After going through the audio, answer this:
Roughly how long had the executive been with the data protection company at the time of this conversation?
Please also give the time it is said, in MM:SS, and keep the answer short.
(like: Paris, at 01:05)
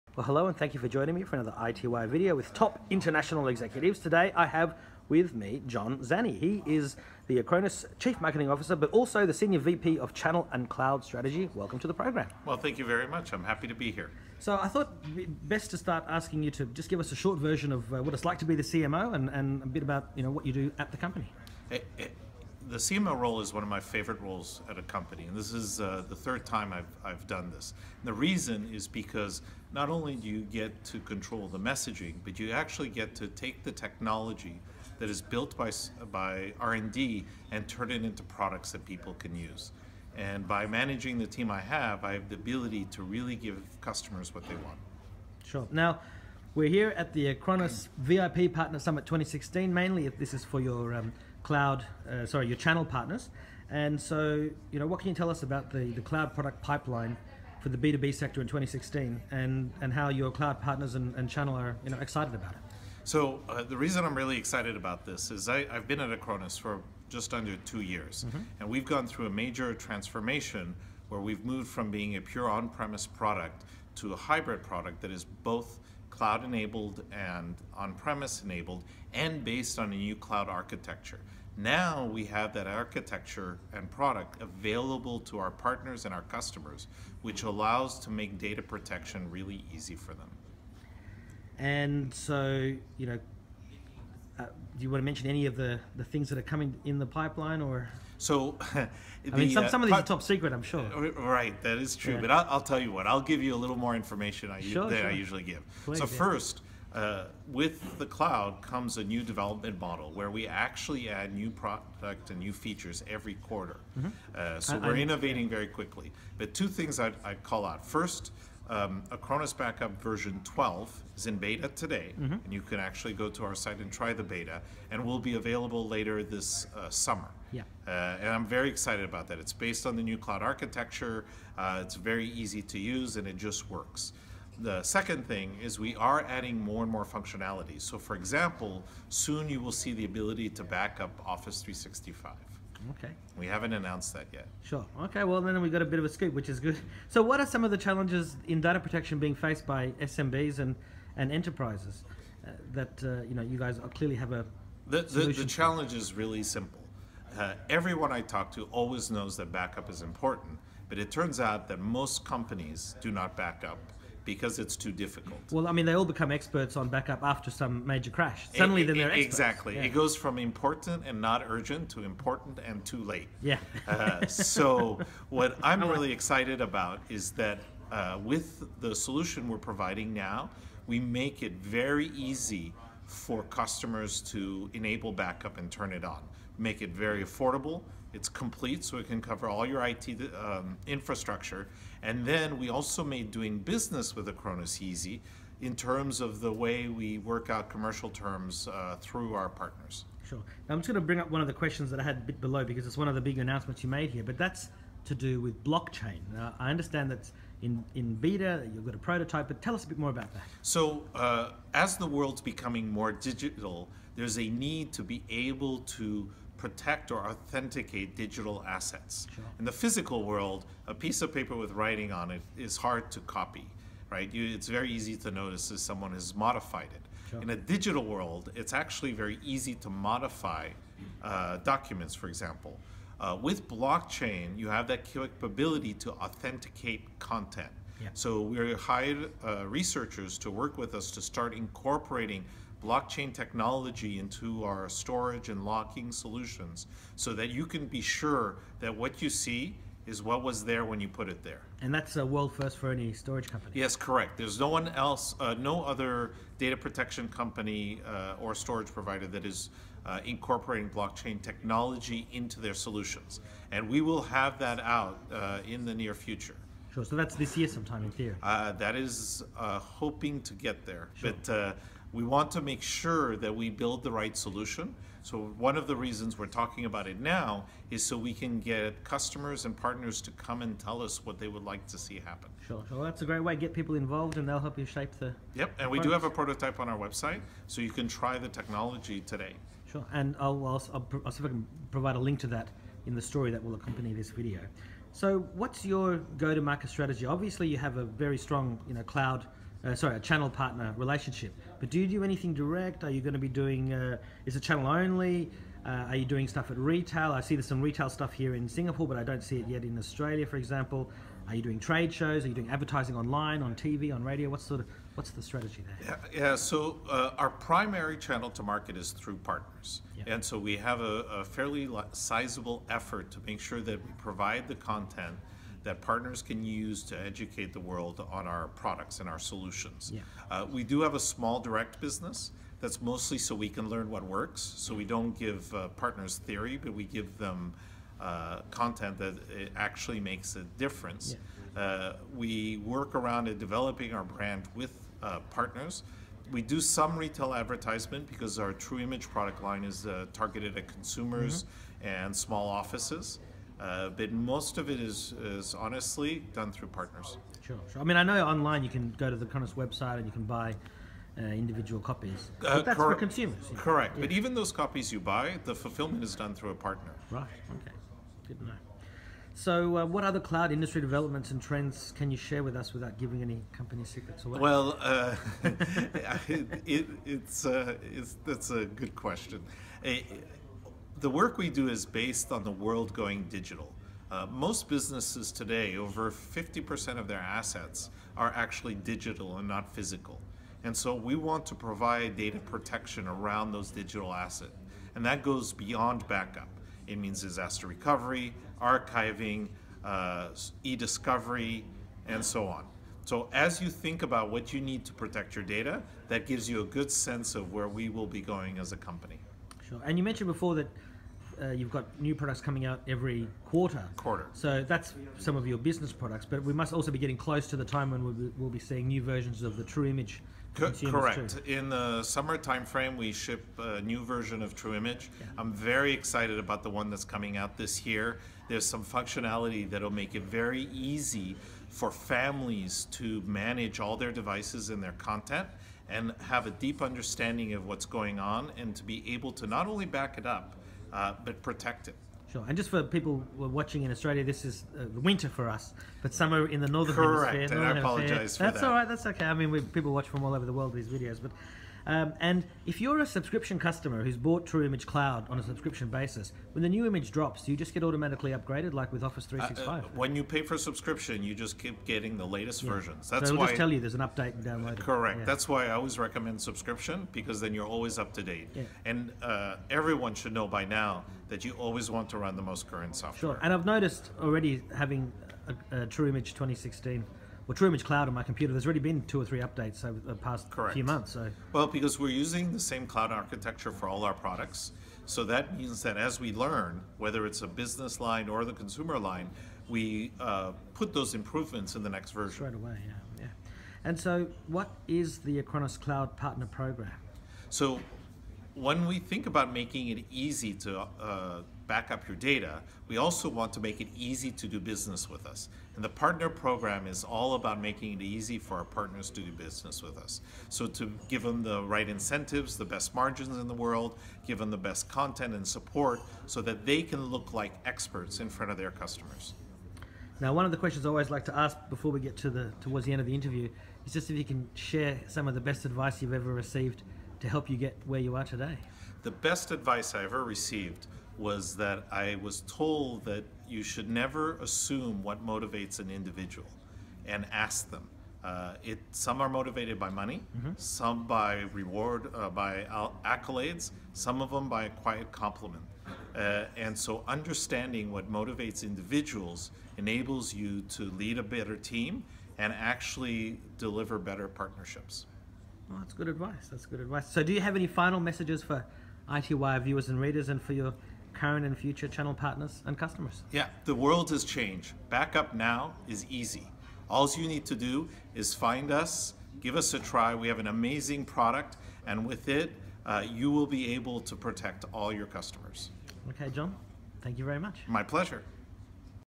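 just under two years, at 01:07.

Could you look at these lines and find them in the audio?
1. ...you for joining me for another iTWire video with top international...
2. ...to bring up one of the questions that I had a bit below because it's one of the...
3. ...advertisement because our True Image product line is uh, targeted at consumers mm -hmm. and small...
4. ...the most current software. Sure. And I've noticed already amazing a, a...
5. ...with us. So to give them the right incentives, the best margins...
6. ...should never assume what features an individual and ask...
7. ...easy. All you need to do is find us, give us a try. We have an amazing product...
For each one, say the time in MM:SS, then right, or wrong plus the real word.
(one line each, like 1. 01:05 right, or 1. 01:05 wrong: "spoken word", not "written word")
1. 00:00 right
2. 03:20 right
3. 05:47 right
4. 07:52 wrong: "having", not "amazing"
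5. 08:30 right
6. 08:53 wrong: "motivates", not "features"
7. 09:26 right.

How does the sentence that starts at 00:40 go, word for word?
And by managing the team I have, I have the ability to really give customers what they want.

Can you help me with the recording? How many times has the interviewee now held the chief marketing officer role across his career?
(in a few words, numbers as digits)
3.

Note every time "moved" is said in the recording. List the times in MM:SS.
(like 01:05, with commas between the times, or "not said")
01:11.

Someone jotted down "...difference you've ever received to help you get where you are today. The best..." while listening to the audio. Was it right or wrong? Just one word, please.
wrong.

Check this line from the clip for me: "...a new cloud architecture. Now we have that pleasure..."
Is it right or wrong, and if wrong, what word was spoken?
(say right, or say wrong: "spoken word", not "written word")
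wrong: "architecture", not "pleasure".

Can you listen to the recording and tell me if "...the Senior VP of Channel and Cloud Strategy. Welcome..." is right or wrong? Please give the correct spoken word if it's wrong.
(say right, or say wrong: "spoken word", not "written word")
right.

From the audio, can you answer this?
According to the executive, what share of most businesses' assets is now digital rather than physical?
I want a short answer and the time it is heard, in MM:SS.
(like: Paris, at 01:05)
over 50%, at 06:25.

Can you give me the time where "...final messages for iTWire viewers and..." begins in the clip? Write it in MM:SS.
09:17.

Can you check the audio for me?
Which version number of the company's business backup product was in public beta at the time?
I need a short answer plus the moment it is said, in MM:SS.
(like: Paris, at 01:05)
12, at 02:00.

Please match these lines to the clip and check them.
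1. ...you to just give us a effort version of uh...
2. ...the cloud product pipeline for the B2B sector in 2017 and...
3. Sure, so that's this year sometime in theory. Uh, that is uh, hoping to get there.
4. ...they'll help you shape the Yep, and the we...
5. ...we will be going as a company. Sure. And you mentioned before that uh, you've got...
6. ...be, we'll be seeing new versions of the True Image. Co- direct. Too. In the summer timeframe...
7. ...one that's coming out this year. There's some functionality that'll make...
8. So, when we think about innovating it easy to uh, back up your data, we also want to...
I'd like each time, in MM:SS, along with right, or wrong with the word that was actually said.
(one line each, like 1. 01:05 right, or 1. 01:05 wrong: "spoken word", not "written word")
1. 00:16 wrong: "short", not "effort"
2. 00:55 wrong: "2016", not "2017"
3. 04:26 right
4. 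04:44 right
5. 06:47 right
6. 06:58 wrong: "correct", not "direct"
7. 07:06 right
8. 08:17 wrong: "making", not "innovating".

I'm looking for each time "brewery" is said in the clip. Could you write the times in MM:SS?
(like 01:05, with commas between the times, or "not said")
not said.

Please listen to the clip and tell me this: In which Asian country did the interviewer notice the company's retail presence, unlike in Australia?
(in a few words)
Singapore.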